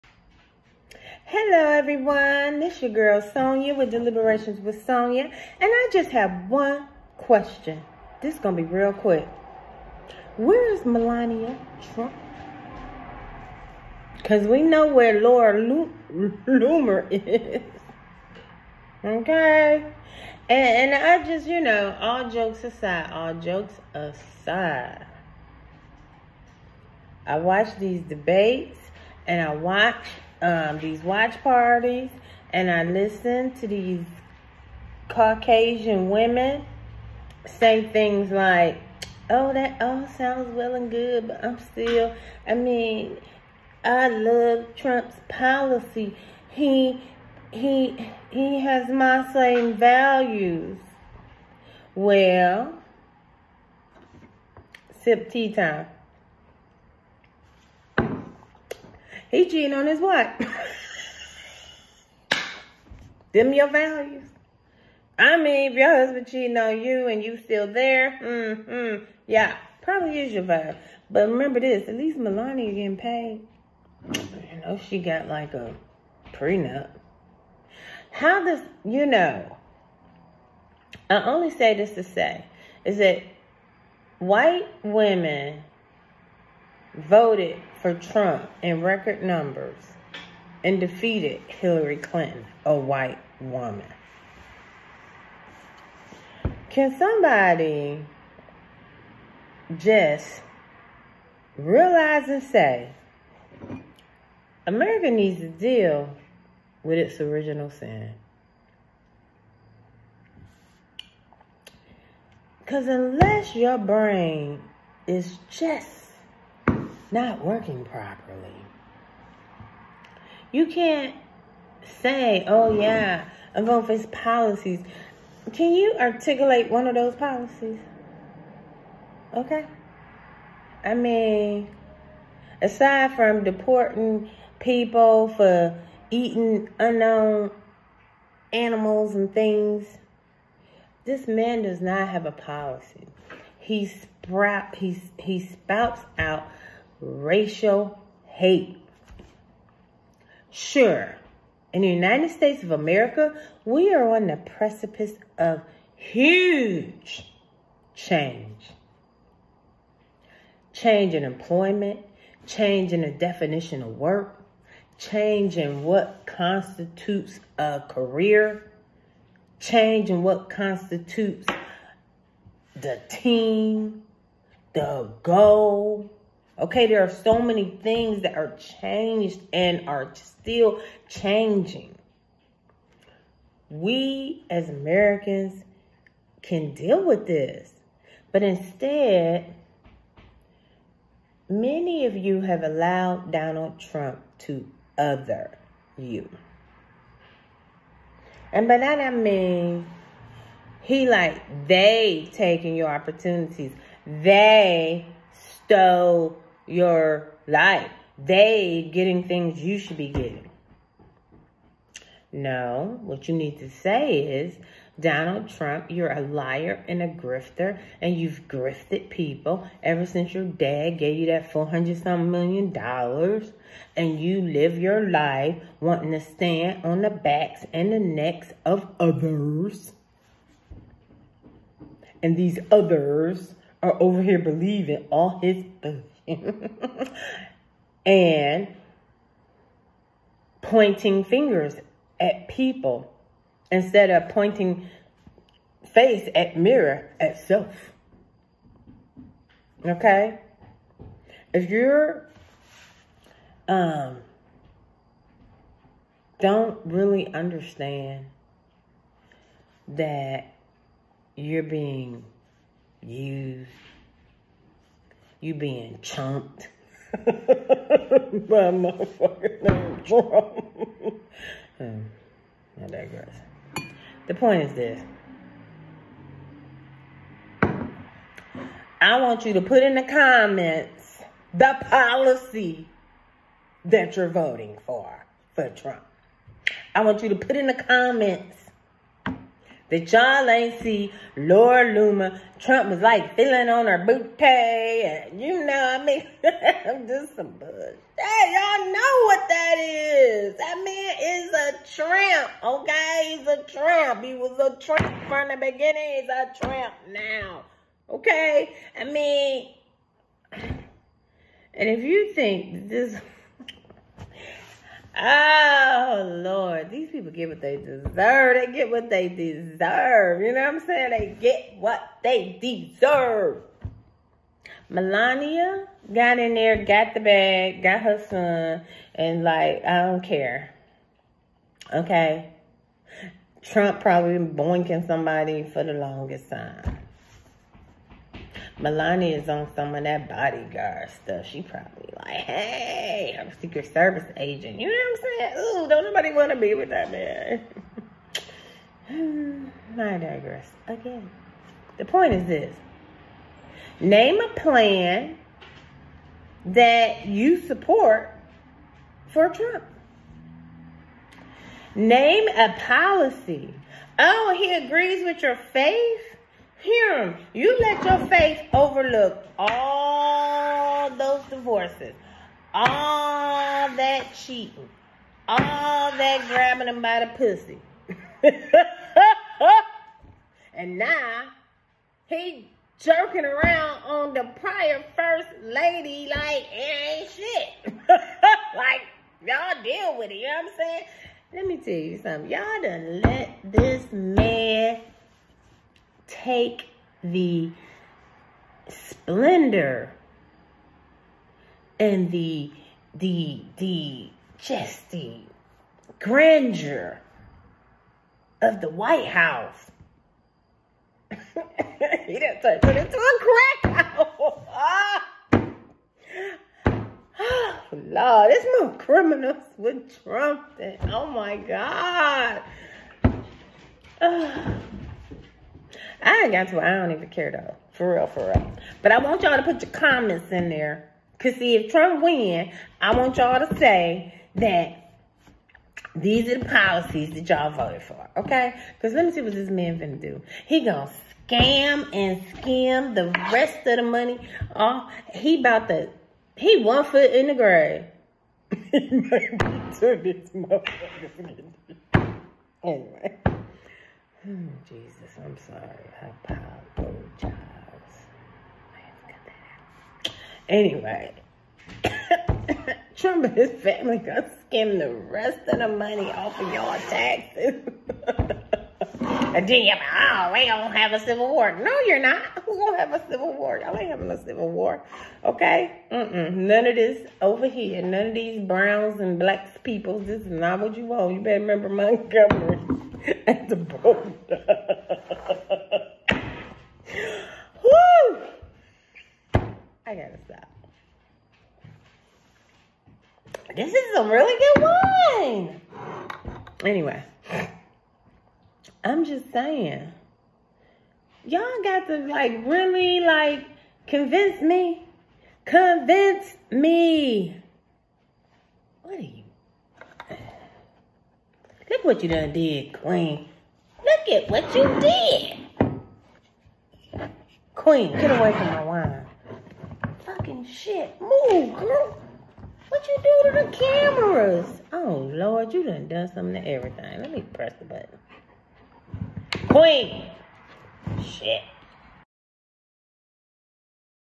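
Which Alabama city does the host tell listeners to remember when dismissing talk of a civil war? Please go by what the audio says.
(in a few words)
Montgomery.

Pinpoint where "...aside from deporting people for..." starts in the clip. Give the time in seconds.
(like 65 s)
132 s.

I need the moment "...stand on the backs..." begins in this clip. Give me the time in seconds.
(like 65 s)
226 s.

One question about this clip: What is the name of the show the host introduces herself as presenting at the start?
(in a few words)
Deliberations with Sonya.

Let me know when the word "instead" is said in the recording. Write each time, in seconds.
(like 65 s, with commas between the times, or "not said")
188 s, 243 s.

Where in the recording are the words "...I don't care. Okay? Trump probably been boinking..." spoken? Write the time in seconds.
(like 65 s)
329 s.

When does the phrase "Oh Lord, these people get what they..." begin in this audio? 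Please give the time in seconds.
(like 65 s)
315 s.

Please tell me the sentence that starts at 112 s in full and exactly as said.
Because unless your brain is just not working properly.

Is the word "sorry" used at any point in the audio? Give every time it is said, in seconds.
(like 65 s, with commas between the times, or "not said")
455 s.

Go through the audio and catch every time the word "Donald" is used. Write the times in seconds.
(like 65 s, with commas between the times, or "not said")
193 s, 214 s.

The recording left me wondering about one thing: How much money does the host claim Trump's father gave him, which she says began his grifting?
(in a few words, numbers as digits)
400 some million dollars.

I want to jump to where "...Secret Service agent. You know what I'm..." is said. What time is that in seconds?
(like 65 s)
343 s.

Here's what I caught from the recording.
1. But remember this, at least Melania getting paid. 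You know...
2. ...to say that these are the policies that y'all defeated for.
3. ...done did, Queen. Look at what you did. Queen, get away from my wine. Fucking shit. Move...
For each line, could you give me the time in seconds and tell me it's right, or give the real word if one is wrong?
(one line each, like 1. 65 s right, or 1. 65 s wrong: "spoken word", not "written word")
1. 71 s right
2. 433 s wrong: "voted", not "defeated"
3. 512 s right.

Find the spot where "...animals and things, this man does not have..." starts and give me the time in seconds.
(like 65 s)
138 s.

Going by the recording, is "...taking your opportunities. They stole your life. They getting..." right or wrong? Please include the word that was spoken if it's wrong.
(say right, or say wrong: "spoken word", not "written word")
right.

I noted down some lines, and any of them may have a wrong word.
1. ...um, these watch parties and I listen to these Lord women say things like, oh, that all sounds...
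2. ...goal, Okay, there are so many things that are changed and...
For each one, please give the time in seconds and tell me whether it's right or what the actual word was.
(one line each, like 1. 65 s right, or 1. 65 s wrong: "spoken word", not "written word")
1. 30 s wrong: "Caucasian", not "Lord"
2. 175 s right.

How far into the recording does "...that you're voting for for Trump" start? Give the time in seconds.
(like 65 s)
283 s.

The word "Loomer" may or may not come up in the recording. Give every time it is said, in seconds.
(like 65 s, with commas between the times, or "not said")
15 s, 291 s.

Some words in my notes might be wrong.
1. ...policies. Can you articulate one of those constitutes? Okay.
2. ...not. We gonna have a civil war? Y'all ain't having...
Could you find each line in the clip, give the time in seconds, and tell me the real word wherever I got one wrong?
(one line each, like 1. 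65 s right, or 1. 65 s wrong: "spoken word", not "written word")
1. 124 s wrong: "policies", not "constitutes"
2. 472 s right.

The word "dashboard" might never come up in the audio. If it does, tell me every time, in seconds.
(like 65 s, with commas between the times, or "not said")
not said.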